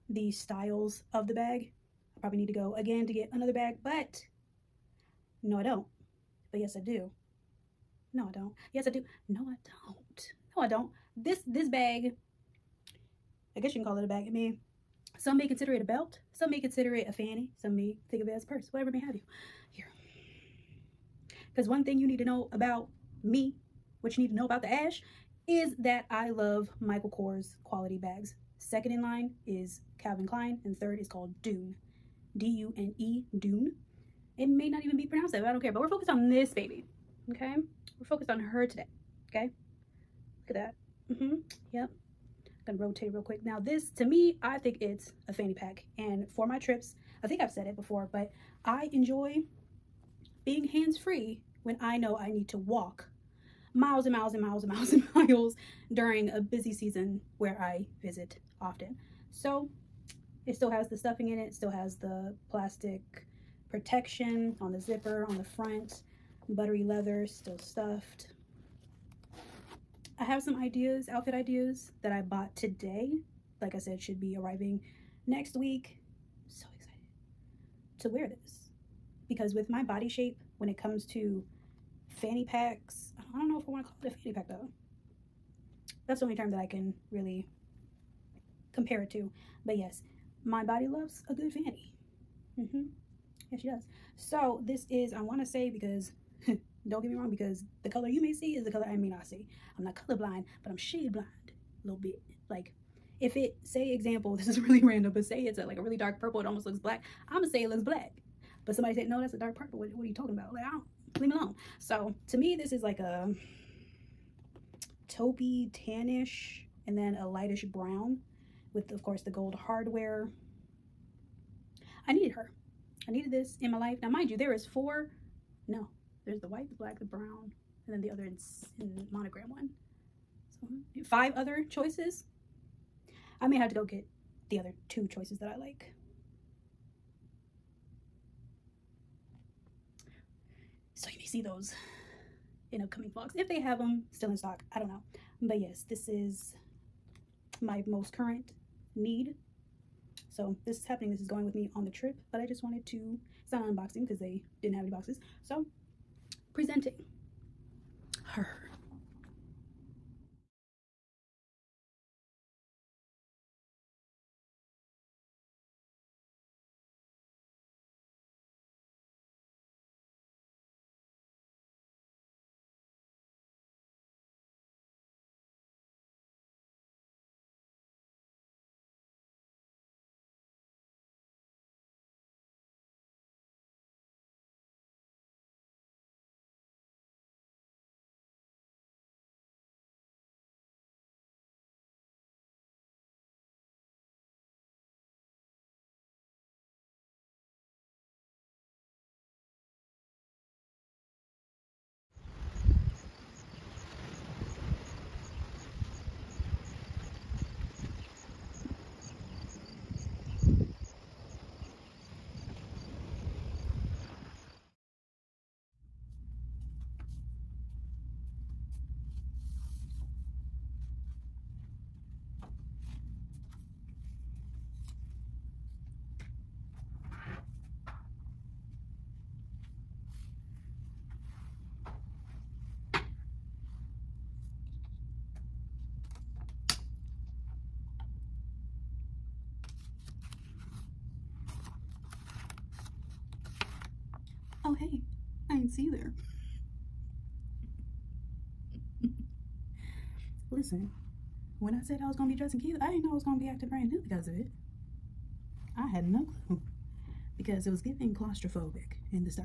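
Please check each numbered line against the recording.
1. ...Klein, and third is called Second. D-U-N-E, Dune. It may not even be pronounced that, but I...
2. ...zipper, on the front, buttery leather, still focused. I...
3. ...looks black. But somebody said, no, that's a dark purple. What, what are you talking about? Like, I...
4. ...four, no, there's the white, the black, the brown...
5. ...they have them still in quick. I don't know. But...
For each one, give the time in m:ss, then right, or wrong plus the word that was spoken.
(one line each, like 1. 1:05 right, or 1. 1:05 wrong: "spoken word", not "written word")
1. 0:30 wrong: "Dune", not "Second"
2. 1:04 wrong: "stuffed", not "focused"
3. 1:47 right
4. 2:04 right
5. 2:23 wrong: "stock", not "quick".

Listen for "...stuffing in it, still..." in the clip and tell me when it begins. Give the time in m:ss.
1:00.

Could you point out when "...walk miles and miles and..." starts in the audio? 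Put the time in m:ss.
0:52.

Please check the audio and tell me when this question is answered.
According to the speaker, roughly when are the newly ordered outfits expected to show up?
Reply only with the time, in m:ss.
1:15.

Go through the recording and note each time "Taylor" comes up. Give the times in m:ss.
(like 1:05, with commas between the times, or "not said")
not said.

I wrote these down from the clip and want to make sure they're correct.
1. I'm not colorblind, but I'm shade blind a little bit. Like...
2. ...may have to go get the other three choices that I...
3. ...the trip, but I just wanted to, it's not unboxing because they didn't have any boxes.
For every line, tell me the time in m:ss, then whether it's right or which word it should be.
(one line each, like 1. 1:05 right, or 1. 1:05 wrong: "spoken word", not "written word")
1. 1:39 right
2. 2:13 wrong: "two", not "three"
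3. 2:31 right.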